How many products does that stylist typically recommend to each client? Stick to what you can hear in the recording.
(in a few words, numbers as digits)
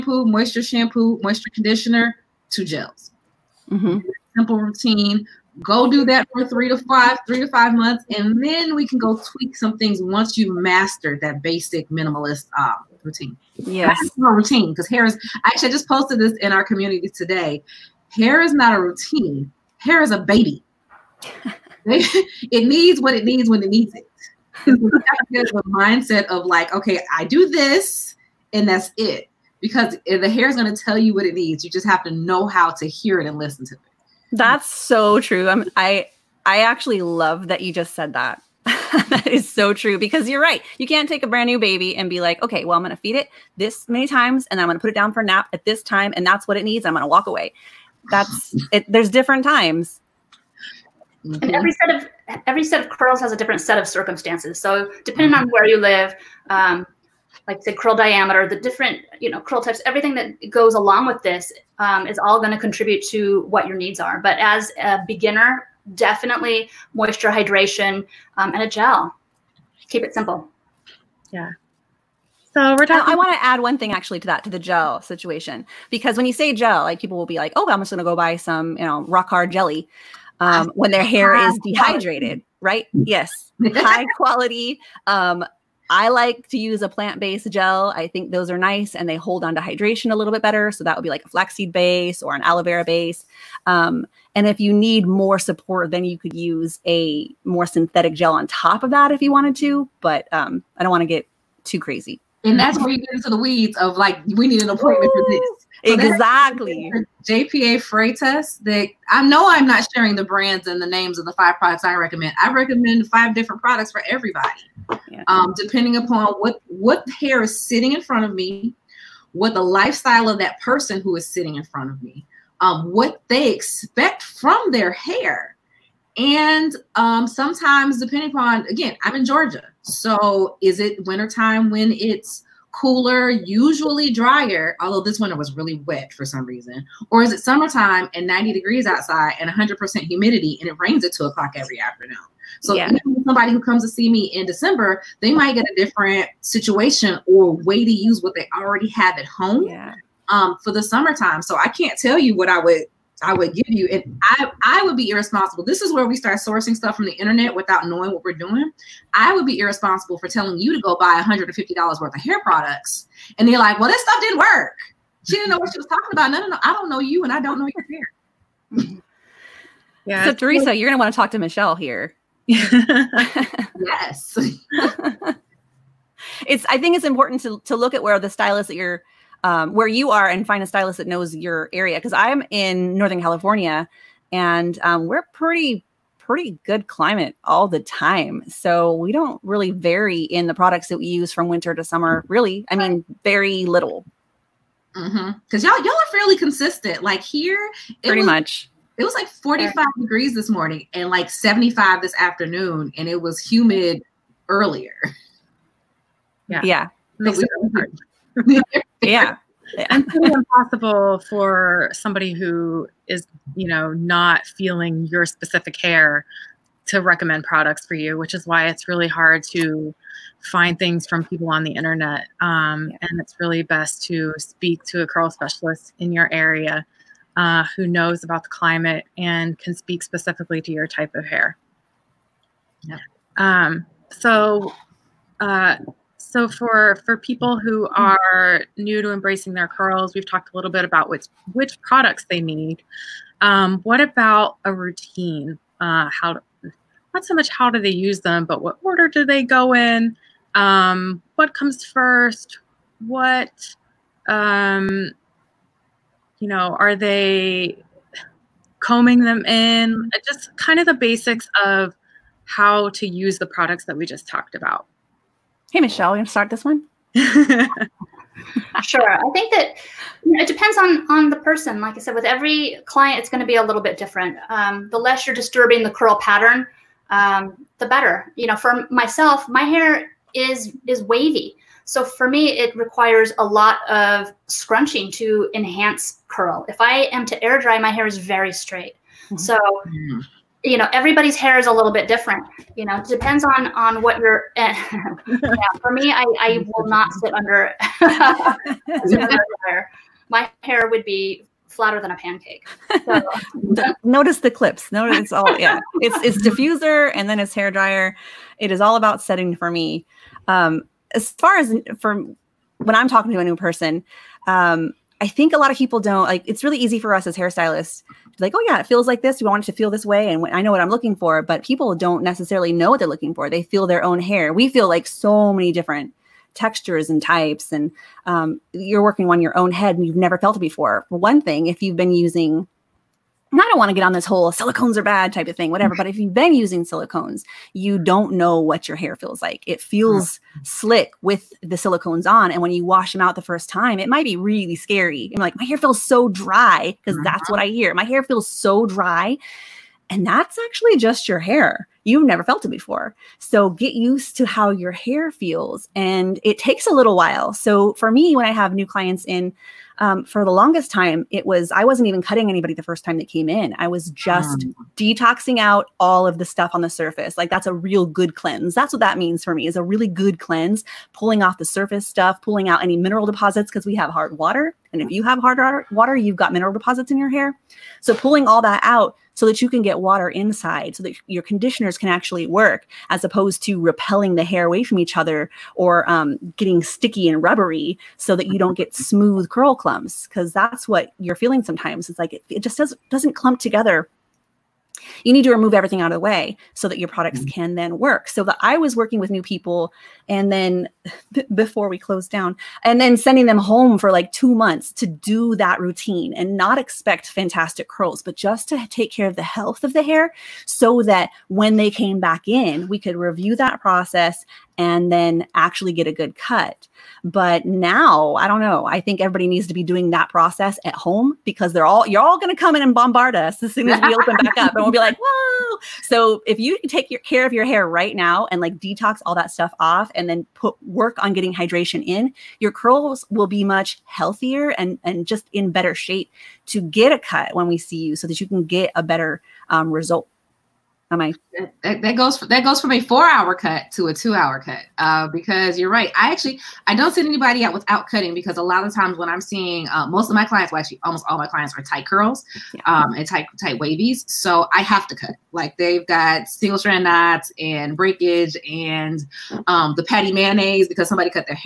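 5.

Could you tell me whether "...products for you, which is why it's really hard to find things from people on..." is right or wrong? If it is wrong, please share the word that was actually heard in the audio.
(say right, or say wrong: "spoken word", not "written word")
right.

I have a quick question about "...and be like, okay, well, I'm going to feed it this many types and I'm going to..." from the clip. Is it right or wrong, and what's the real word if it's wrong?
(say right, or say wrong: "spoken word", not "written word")
wrong: "times", not "types".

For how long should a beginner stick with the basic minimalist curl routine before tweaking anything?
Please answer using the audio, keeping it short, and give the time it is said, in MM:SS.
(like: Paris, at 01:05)
3 to 5 months, at 00:07.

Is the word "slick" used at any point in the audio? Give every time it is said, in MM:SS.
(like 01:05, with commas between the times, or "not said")
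05:40.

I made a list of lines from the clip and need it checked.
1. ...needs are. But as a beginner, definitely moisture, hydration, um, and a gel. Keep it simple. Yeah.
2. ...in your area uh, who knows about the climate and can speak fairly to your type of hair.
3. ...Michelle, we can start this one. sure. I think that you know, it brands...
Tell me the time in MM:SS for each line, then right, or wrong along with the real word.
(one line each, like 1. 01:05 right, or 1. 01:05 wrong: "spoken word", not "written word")
1. 01:03 right
2. 03:45 wrong: "specifically", not "fairly"
3. 04:25 wrong: "depends", not "brands".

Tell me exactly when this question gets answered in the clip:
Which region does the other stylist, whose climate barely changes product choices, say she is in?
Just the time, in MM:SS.
03:02.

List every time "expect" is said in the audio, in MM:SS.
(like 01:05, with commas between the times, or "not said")
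02:03, 06:46.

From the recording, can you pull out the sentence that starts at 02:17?
Or is it summertime and 90 degrees outside and 100% humidity and it rains at two o'clock every afternoon?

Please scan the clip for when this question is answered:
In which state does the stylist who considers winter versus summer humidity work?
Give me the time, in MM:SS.
02:09.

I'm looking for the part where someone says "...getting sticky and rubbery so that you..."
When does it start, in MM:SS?
06:26.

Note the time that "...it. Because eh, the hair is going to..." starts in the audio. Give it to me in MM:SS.
00:28.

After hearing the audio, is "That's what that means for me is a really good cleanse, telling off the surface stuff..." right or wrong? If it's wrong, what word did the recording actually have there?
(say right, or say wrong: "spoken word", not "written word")
wrong: "pulling", not "telling".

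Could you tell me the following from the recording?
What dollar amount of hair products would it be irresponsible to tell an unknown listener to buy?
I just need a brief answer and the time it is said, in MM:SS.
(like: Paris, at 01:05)
$150, at 02:41.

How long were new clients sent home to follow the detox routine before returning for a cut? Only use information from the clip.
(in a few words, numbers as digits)
2 months.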